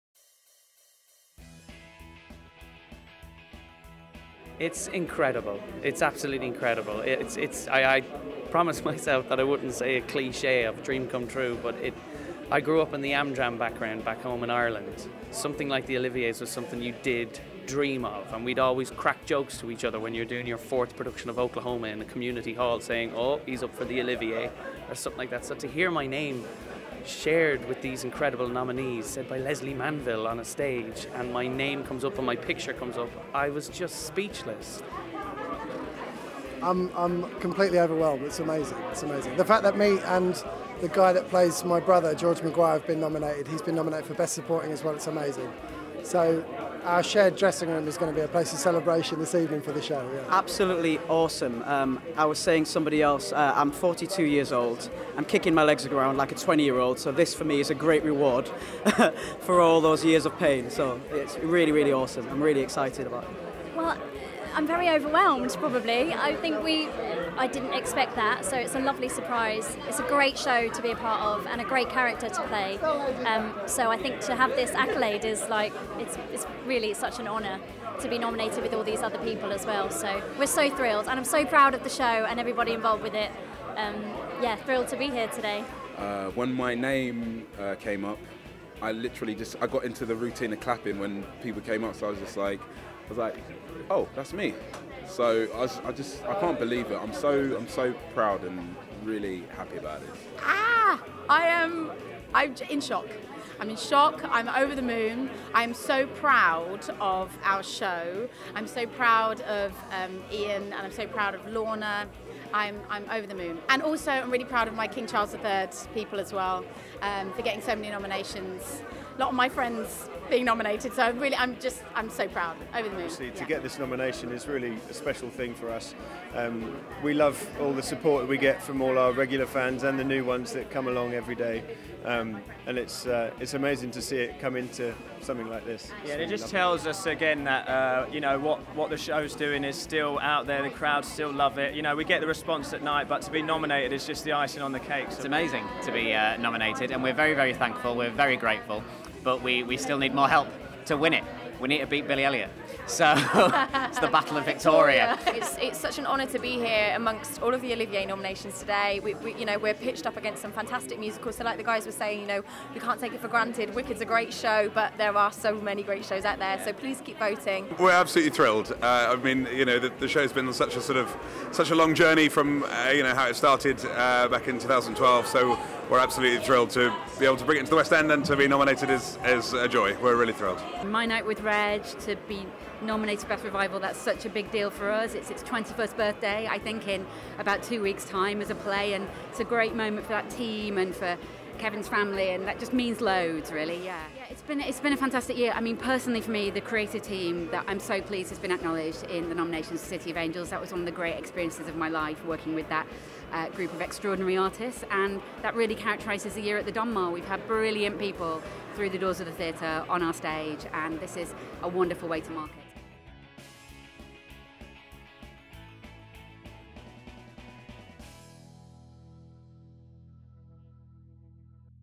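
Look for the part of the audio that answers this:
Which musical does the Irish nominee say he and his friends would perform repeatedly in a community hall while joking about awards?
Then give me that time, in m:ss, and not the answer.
0:21.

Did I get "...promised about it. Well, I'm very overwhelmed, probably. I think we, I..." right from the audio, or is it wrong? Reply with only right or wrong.
wrong.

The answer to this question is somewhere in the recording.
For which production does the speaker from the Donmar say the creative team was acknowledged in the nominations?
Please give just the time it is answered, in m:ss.
3:19.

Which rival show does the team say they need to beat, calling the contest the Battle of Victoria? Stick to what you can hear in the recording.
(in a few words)
Billy Elliot.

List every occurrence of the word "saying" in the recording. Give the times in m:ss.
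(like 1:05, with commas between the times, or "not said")
0:22, 0:52, 2:41.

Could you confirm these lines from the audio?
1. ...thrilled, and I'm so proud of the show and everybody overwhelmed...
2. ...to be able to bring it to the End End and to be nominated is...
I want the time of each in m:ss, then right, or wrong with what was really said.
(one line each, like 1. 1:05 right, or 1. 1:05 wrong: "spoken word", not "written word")
1. 1:20 wrong: "involved", not "overwhelmed"
2. 2:56 wrong: "West", not "End".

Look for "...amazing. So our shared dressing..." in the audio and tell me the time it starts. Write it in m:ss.
0:45.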